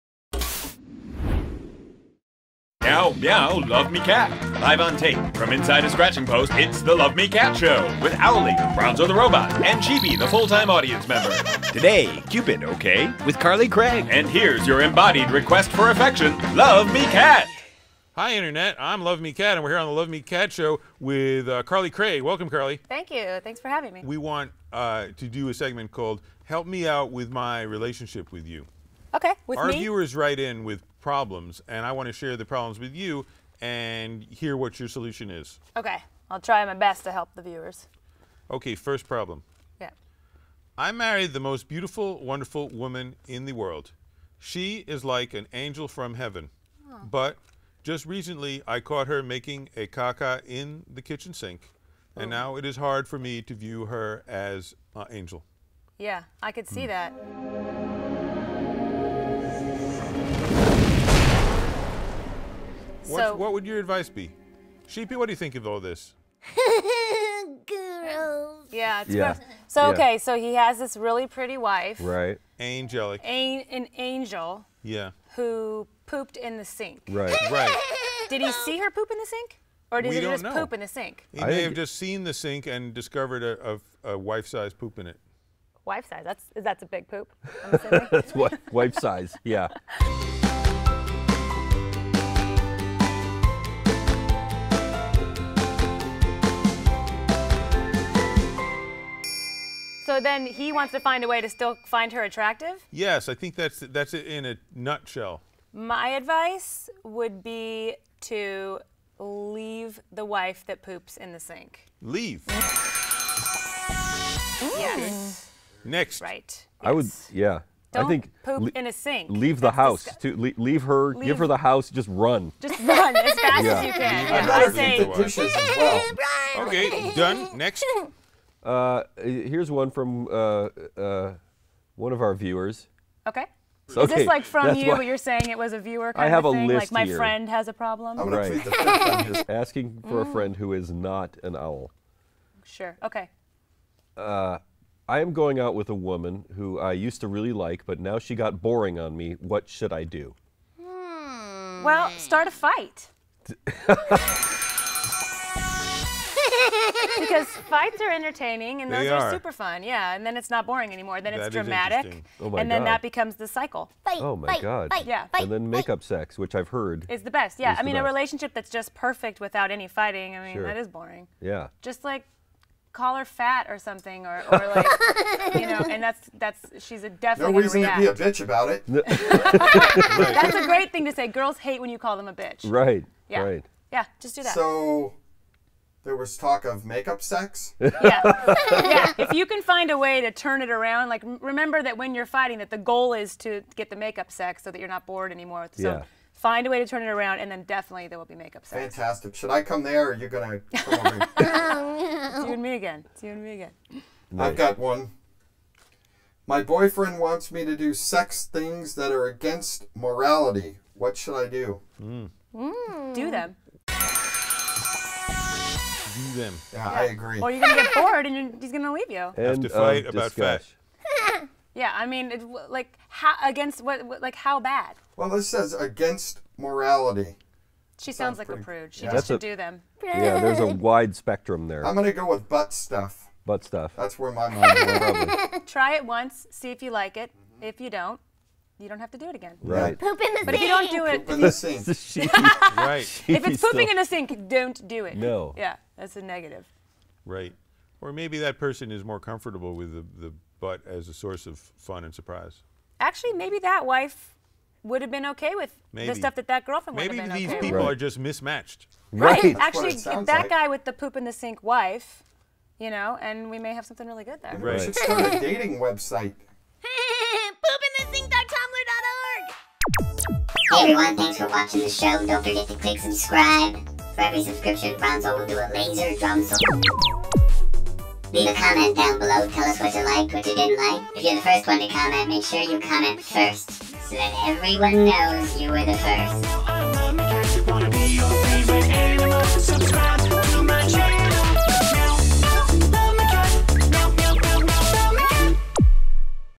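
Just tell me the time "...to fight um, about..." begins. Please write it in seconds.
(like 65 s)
219 s.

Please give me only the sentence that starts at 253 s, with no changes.
Actually, maybe that wife would have been okay with maybe.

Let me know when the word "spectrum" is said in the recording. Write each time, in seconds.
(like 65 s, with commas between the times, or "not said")
231 s.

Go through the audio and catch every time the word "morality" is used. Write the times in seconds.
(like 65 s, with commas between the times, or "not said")
209 s, 226 s.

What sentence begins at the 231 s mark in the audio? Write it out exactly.
I'm gonna go with butt stuff.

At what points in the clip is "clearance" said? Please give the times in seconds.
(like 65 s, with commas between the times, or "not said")
not said.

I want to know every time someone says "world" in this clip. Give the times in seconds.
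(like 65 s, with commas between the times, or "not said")
43 s.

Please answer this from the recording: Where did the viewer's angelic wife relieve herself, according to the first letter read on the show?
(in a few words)
kitchen sink.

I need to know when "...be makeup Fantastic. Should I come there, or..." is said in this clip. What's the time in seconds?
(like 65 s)
198 s.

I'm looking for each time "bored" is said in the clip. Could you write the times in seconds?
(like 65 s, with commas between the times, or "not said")
195 s, 217 s.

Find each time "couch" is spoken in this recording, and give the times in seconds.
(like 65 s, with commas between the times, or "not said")
not said.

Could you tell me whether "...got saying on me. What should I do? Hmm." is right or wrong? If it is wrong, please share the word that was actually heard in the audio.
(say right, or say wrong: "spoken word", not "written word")
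wrong: "boring", not "saying".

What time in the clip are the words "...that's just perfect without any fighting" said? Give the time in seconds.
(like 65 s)
168 s.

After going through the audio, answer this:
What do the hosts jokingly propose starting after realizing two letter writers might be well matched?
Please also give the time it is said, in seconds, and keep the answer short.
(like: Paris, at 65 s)
A dating website, at 265 s.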